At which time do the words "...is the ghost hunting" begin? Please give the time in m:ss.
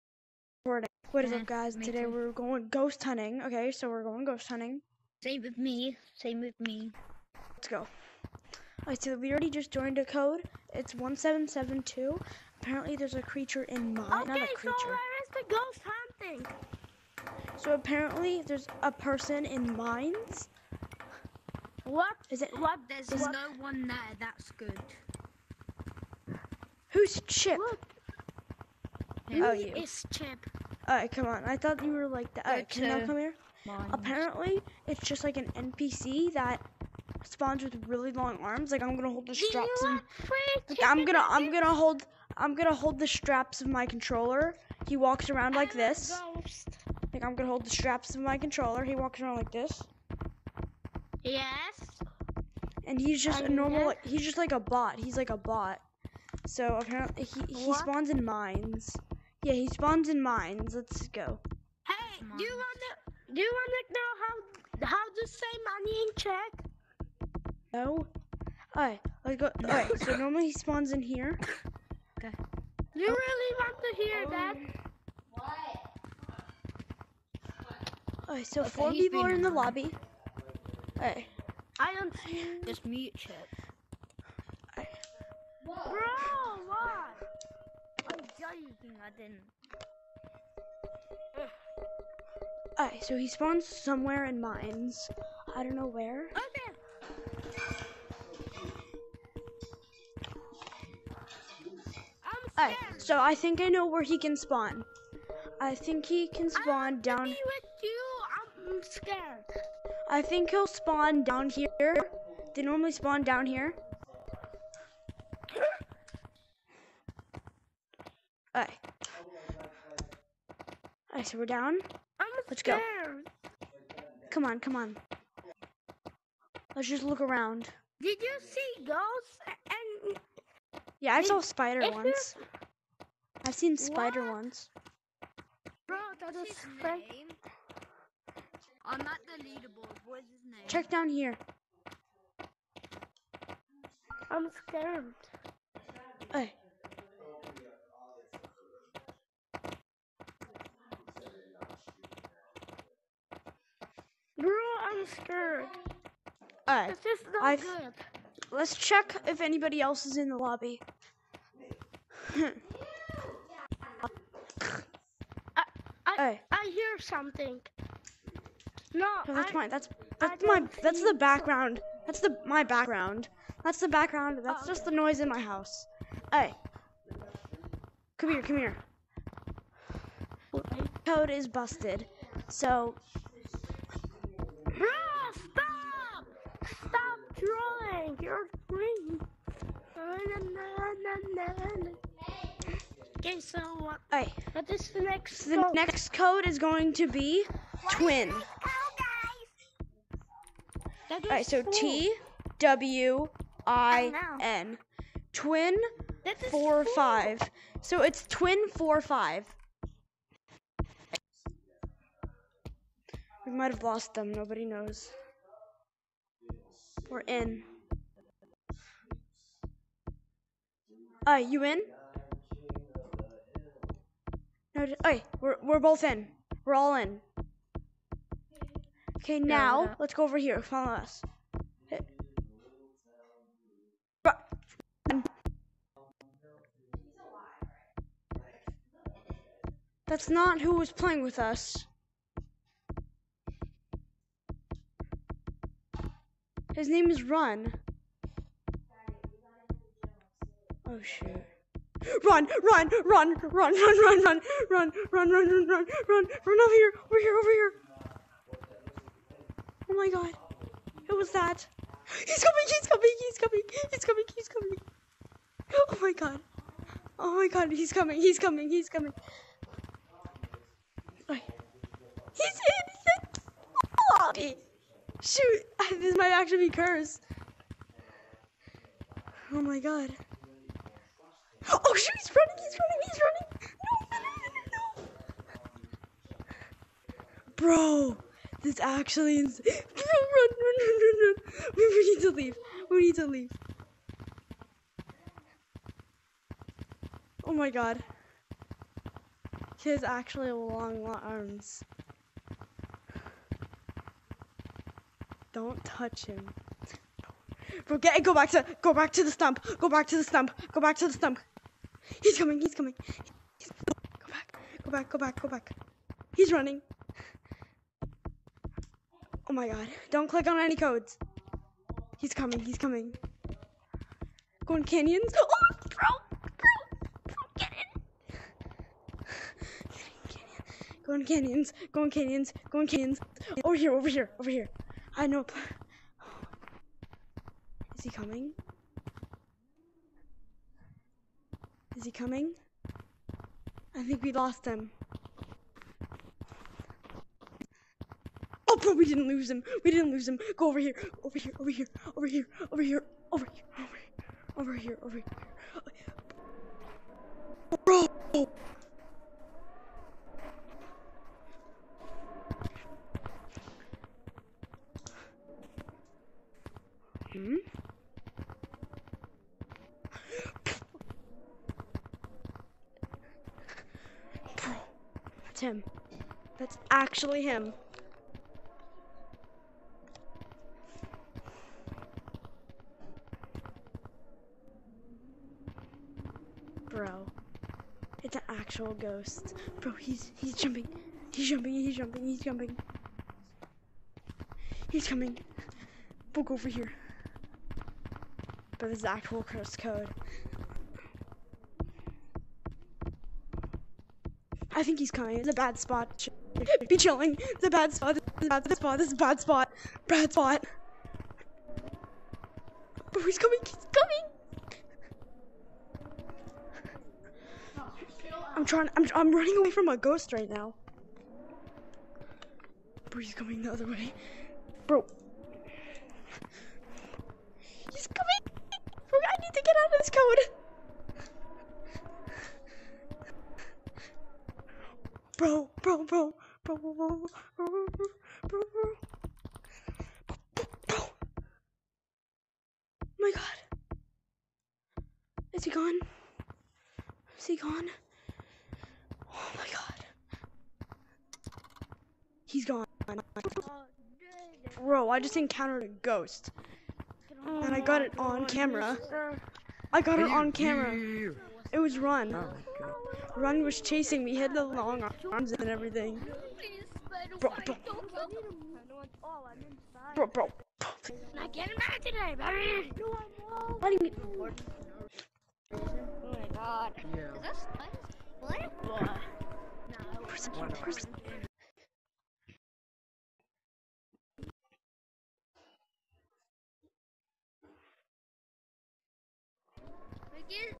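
0:15.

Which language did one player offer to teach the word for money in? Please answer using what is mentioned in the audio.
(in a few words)
Czech.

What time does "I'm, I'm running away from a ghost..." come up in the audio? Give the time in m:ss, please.
6:58.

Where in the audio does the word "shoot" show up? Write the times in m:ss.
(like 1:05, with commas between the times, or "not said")
4:11, 4:35, 4:41.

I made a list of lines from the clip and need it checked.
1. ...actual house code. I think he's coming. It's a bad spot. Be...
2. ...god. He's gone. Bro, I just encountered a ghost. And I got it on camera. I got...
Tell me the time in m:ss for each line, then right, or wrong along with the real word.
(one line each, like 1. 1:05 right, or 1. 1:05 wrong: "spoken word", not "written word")
1. 6:39 wrong: "curse", not "house"
2. 7:29 right.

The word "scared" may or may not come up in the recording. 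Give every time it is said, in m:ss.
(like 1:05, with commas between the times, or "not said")
1:48, 2:24, 2:35.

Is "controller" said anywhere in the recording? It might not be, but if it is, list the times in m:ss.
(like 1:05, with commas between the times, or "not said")
0:43, 0:48.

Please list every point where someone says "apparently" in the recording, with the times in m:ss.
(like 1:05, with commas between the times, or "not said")
0:12, 0:17, 0:33, 0:56.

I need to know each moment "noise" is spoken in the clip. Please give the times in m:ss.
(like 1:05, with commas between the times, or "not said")
2:54.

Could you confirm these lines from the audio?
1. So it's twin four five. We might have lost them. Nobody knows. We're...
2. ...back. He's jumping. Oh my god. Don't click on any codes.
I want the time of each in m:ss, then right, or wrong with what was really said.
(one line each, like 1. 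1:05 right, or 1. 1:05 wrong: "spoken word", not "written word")
1. 3:27 right
2. 5:15 wrong: "running", not "jumping".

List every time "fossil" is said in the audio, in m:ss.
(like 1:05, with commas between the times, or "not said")
not said.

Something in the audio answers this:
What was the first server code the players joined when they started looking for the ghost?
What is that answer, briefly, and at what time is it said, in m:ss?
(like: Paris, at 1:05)
1772, at 0:10.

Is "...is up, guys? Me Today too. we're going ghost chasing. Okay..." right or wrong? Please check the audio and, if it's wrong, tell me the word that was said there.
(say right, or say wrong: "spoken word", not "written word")
wrong: "hunting", not "chasing".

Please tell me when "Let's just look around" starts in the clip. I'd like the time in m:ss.
2:06.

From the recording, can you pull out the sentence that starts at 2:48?
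No, no that's I, my that's that's my that's the background.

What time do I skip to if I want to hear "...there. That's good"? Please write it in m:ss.
0:23.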